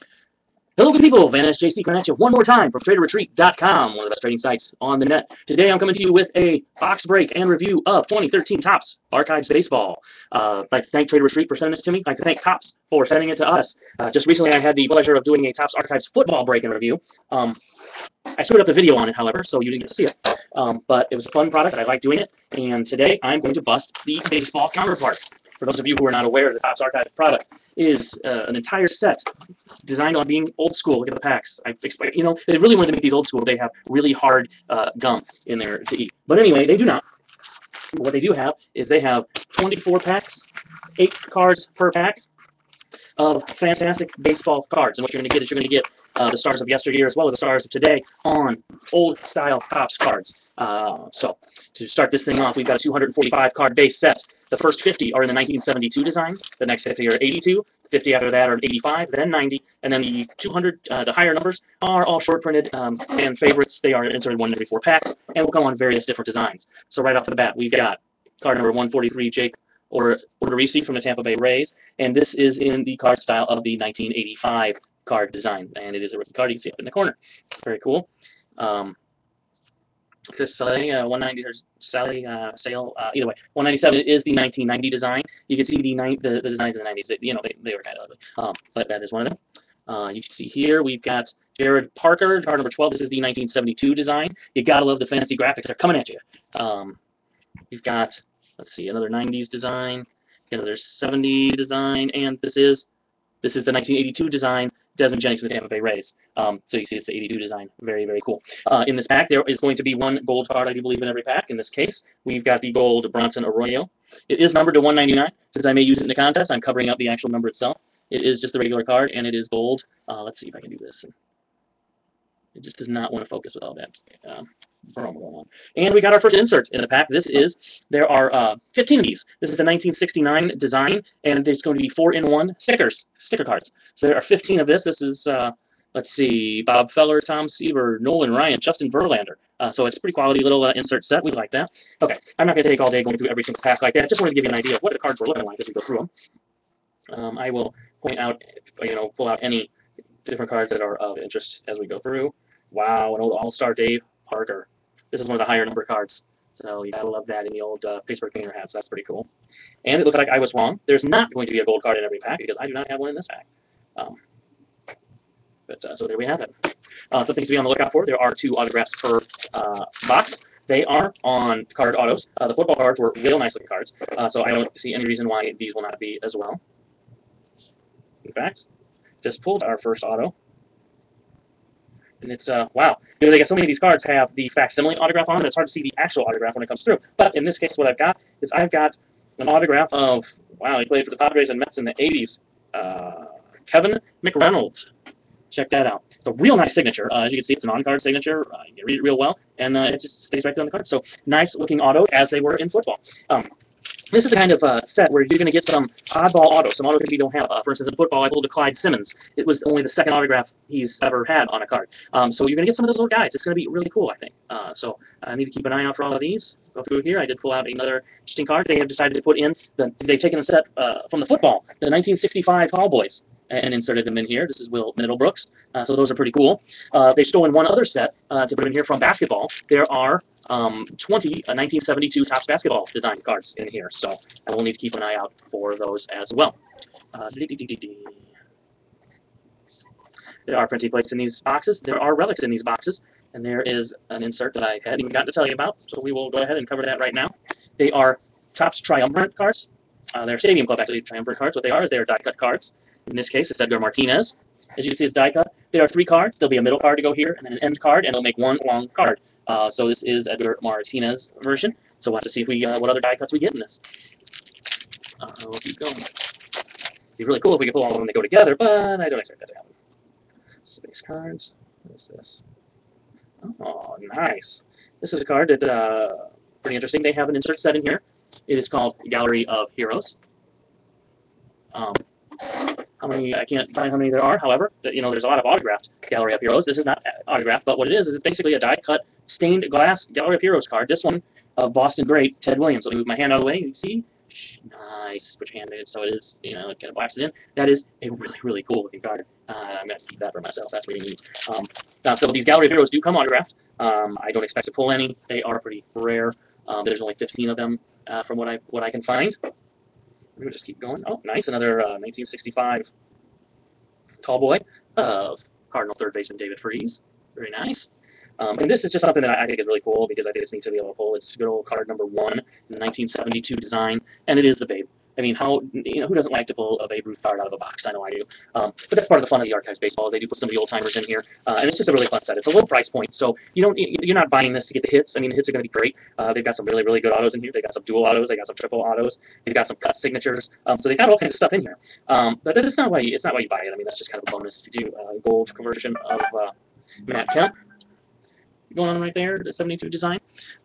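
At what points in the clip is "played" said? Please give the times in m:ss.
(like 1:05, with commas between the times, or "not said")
3:10.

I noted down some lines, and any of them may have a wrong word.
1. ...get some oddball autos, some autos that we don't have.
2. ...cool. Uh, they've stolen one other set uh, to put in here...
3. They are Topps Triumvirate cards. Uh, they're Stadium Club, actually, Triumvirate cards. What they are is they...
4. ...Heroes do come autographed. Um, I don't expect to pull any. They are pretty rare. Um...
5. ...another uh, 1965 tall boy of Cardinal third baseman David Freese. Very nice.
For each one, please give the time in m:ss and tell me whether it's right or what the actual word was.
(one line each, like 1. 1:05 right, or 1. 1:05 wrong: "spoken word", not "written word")
1. 3:25 right
2. 3:46 right
3. 4:07 right
4. 5:02 right
5. 5:11 right.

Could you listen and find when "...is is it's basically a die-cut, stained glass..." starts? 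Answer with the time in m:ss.
4:47.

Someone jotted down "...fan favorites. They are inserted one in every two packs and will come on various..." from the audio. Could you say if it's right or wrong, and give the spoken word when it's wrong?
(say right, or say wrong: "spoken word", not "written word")
wrong: "four", not "two".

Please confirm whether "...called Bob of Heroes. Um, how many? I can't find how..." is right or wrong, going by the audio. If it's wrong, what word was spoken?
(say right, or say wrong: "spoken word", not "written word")
wrong: "Gallery", not "Bob".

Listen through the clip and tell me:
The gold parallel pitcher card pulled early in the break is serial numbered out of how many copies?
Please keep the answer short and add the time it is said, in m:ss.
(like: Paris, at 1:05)
199, at 1:54.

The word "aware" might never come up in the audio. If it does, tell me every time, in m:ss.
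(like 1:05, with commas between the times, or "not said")
0:26.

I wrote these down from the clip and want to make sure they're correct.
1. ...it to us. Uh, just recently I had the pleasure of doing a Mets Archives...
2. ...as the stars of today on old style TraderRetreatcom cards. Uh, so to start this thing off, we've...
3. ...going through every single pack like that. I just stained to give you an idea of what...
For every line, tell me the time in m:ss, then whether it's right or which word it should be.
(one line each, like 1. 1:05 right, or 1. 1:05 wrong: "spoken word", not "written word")
1. 0:13 wrong: "Topps", not "Mets"
2. 0:47 wrong: "Topps", not "TraderRetreatcom"
3. 2:23 wrong: "wanted", not "stained".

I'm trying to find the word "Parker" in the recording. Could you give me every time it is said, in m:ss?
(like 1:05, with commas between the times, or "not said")
1:31, 2:34.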